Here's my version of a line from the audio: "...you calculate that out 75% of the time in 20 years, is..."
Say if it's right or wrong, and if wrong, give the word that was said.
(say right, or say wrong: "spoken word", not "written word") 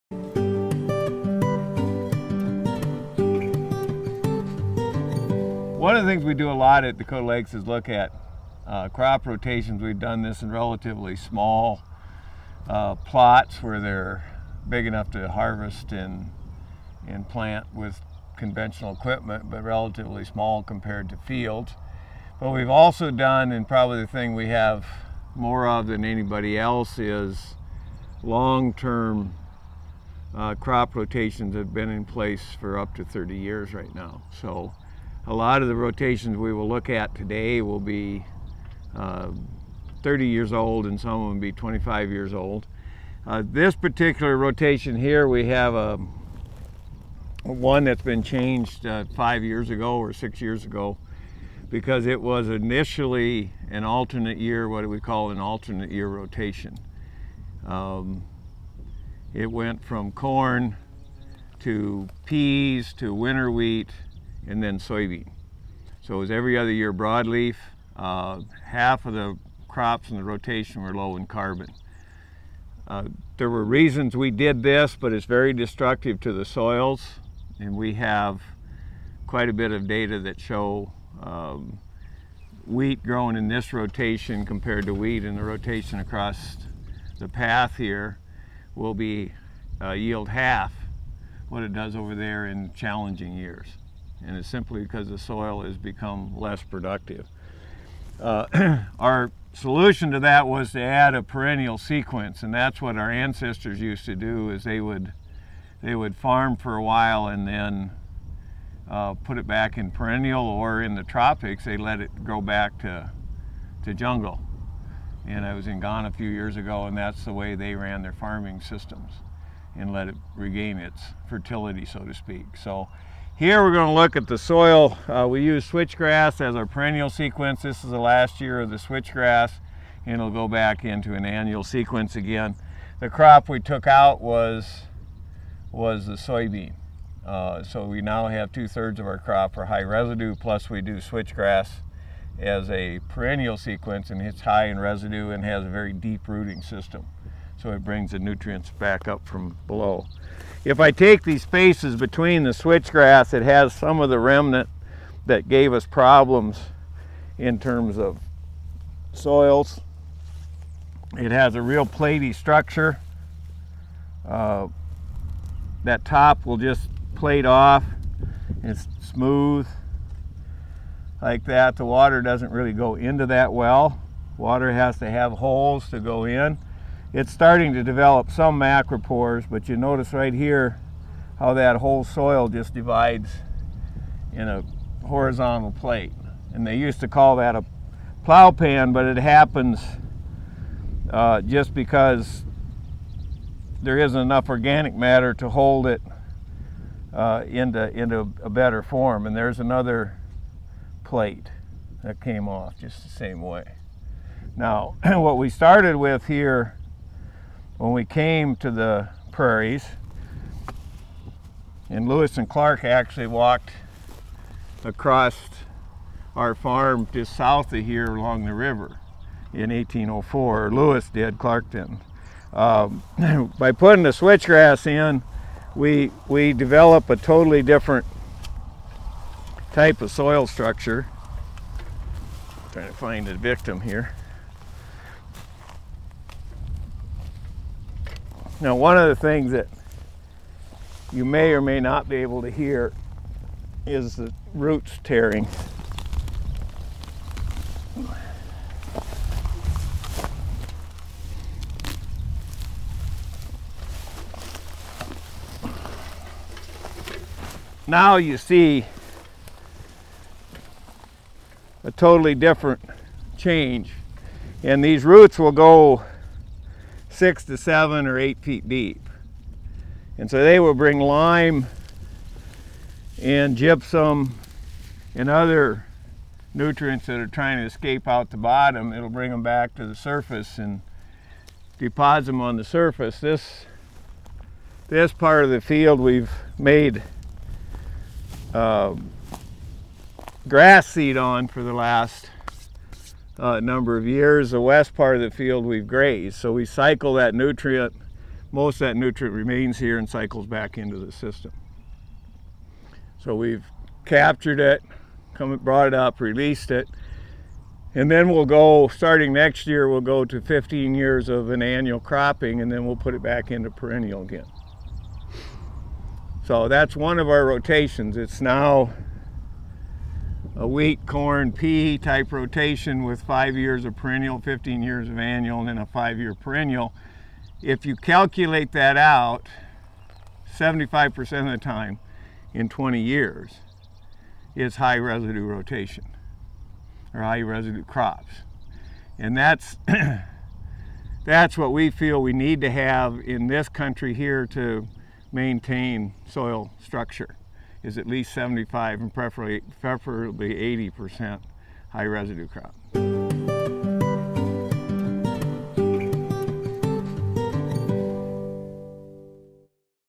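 right.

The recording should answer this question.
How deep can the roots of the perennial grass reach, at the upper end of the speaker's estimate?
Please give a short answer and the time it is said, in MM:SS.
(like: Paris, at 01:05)
8 feet, at 04:28.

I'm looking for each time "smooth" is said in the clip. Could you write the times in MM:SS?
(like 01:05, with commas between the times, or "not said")
02:49.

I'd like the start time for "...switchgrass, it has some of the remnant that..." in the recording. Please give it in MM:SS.
02:32.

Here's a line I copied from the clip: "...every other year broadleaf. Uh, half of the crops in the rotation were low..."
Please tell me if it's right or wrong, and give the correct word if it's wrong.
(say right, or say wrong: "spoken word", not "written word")
right.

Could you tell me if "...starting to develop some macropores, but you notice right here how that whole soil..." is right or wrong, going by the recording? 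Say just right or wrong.
right.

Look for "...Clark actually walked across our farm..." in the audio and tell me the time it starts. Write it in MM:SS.
03:32.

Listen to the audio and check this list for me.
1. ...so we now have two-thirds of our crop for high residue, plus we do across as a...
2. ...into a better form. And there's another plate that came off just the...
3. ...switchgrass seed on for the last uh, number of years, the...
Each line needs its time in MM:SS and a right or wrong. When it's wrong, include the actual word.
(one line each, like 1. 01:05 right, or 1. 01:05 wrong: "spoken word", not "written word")
1. 02:17 wrong: "switchgrass", not "across"
2. 03:17 right
3. 04:50 wrong: "grass", not "switchgrass".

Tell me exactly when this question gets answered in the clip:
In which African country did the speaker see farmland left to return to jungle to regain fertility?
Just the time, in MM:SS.
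01:55.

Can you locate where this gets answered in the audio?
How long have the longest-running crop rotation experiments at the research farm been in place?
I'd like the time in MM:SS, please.
00:32.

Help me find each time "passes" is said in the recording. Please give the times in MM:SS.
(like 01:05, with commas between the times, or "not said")
not said.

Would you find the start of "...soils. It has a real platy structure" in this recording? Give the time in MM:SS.
02:39.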